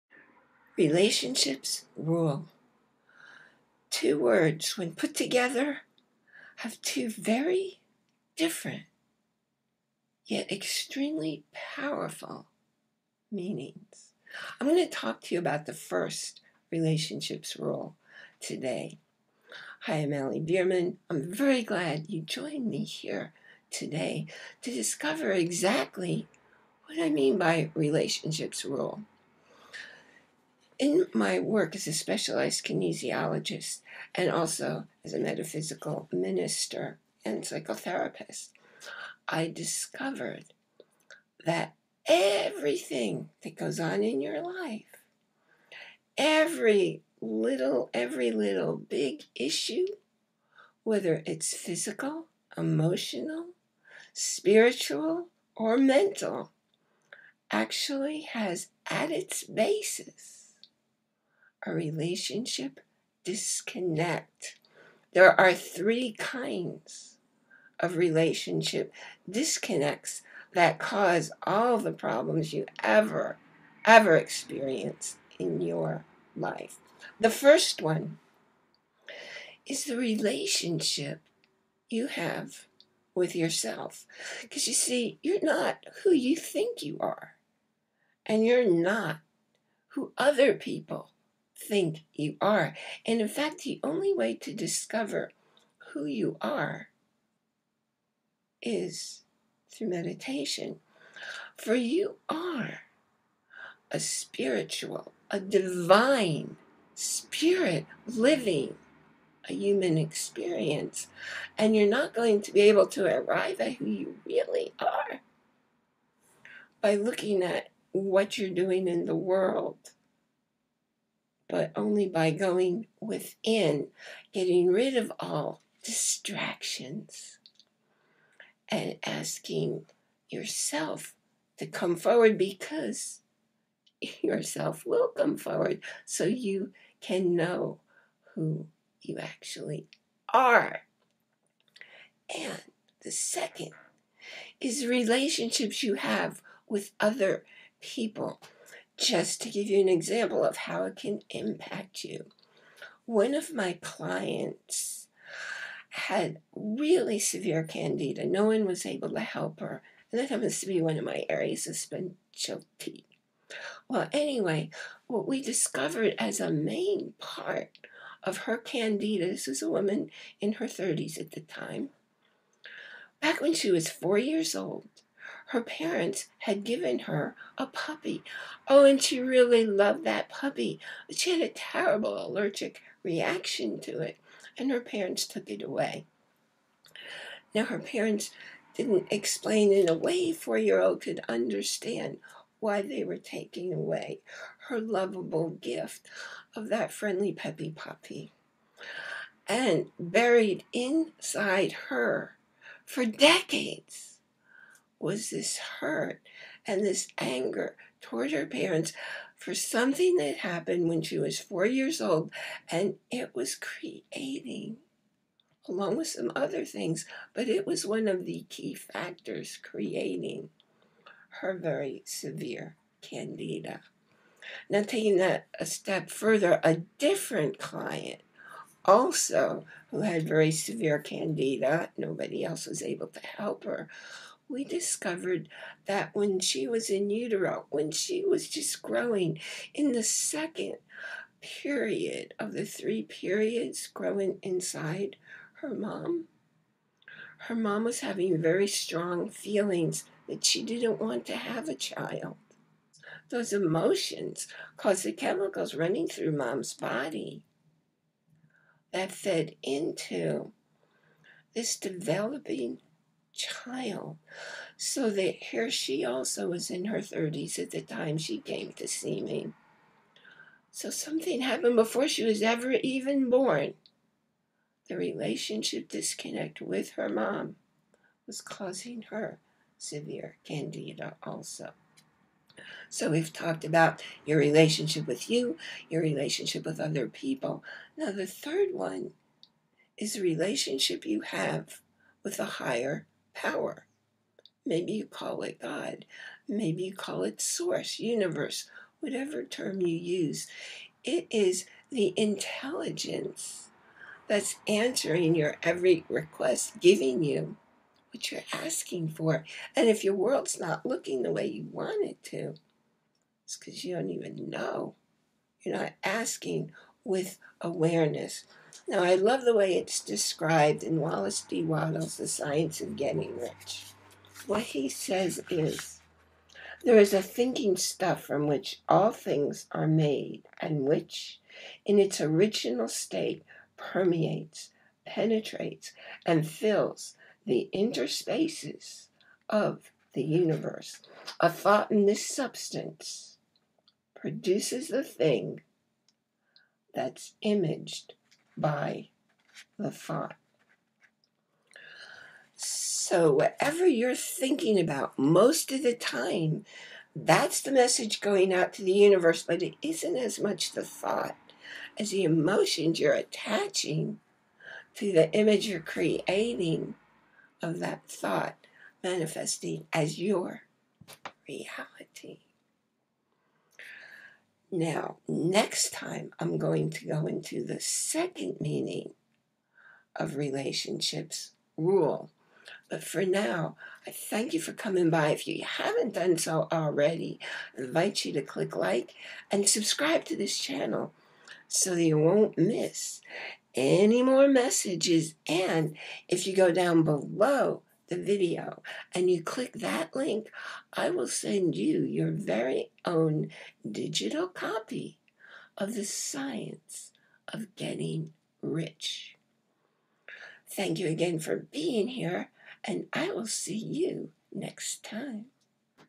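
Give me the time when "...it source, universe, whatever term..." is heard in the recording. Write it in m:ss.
4:57.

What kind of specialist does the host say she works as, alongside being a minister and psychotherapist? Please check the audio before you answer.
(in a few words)
Specialized kinesiologist.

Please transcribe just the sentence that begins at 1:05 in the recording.
There are three kinds of relationship disconnects that cause all the problems you ever, ever experience in your life.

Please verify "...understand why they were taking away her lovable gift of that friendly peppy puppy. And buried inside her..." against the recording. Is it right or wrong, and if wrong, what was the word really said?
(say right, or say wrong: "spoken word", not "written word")
right.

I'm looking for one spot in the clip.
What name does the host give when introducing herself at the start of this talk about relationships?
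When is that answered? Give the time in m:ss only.
0:20.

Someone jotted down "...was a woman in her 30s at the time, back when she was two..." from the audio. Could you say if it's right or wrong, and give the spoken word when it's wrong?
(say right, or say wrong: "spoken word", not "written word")
wrong: "four", not "two".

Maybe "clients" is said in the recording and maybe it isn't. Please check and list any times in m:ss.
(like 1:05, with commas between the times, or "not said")
2:33, 3:47.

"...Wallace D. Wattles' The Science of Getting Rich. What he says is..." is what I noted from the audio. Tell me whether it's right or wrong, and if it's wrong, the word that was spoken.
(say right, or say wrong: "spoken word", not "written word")
right.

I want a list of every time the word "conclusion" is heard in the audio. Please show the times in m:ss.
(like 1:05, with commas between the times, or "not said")
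not said.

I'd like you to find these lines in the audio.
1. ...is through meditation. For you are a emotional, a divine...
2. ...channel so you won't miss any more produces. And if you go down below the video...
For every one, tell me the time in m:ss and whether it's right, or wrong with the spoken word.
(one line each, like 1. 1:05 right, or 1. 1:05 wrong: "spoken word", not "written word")
1. 1:38 wrong: "spiritual", not "emotional"
2. 6:30 wrong: "messages", not "produces".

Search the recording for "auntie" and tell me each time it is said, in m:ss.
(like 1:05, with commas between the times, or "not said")
not said.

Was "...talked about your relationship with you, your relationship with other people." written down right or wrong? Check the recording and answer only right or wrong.
right.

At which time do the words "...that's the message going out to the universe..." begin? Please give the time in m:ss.
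5:57.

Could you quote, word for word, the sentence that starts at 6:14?
Now, next time I'm going to go into the second meaning of relationships rule.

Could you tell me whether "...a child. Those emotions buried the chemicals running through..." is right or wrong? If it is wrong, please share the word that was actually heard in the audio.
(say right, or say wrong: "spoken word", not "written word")
wrong: "caused", not "buried".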